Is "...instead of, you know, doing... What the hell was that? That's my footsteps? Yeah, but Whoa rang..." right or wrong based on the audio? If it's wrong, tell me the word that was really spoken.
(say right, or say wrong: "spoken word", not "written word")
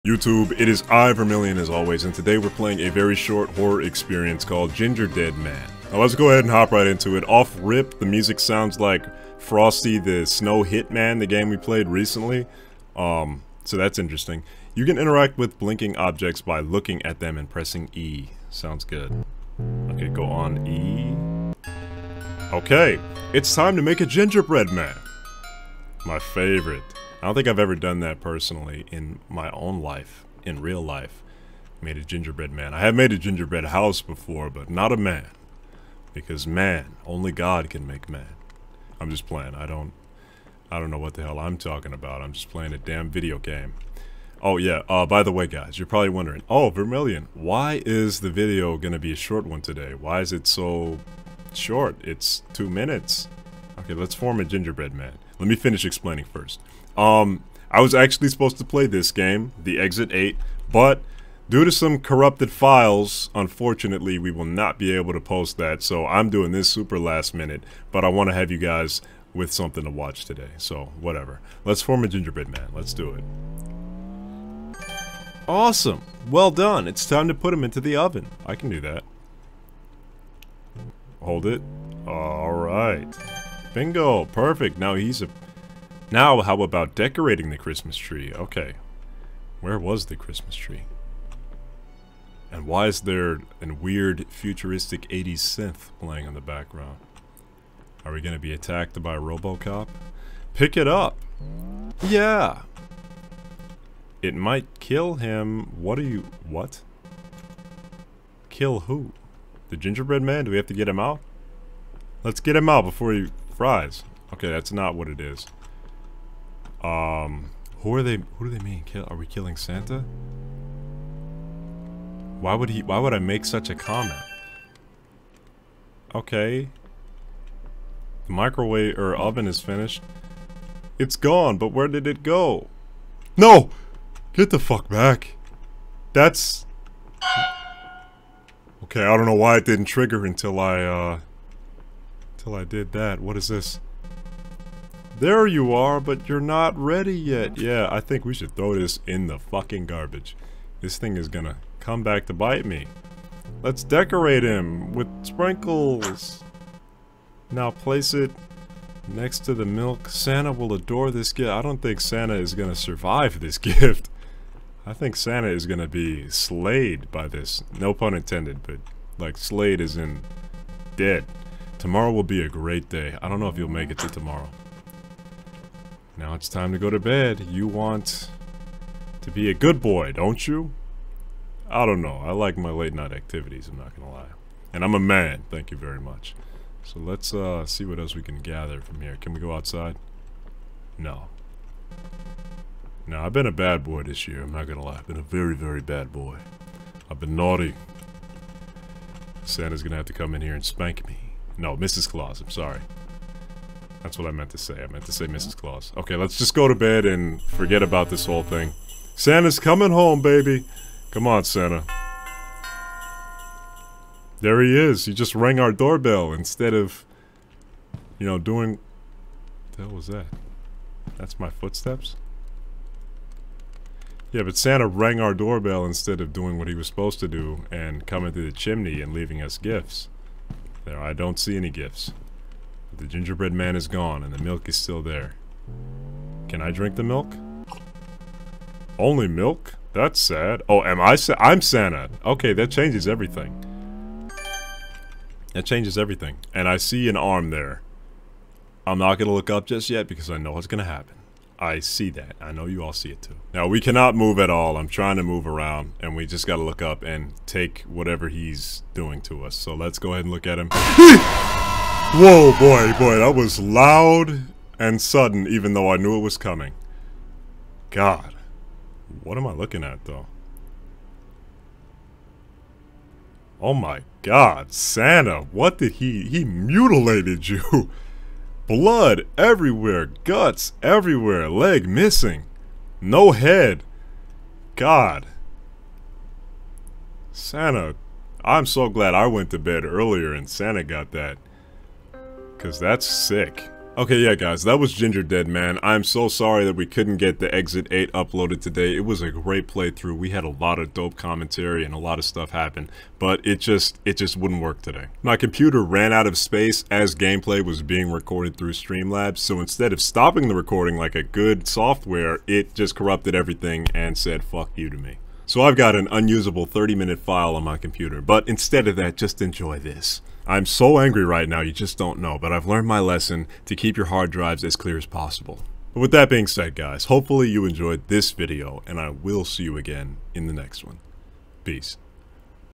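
wrong: "Santa", not "Whoa".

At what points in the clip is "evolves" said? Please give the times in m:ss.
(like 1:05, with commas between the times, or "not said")
not said.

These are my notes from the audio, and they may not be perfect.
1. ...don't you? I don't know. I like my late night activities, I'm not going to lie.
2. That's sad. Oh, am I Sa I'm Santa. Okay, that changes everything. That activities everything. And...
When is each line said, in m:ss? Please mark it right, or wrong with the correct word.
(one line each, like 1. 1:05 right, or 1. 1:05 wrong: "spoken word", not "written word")
1. 3:00 right
2. 3:59 wrong: "changes", not "activities".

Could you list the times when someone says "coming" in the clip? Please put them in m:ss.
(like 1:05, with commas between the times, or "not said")
3:29, 3:48, 4:26.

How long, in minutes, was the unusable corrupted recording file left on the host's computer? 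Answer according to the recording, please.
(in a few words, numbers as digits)
30.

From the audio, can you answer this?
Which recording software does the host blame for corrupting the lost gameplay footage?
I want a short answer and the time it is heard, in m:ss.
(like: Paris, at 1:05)
Streamlabs, at 5:08.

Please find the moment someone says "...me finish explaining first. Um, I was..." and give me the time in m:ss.
0:55.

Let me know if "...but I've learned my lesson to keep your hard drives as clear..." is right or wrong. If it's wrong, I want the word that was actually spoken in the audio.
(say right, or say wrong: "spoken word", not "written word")
right.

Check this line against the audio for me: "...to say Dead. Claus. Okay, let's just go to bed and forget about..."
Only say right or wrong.
wrong.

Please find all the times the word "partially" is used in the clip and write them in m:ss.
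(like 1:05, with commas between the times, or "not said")
not said.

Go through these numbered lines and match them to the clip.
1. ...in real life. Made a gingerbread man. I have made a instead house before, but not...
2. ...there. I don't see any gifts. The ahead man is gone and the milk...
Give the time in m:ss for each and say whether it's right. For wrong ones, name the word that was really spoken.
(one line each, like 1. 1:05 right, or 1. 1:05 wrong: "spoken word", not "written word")
1. 0:30 wrong: "gingerbread", not "instead"
2. 3:50 wrong: "gingerbread", not "ahead".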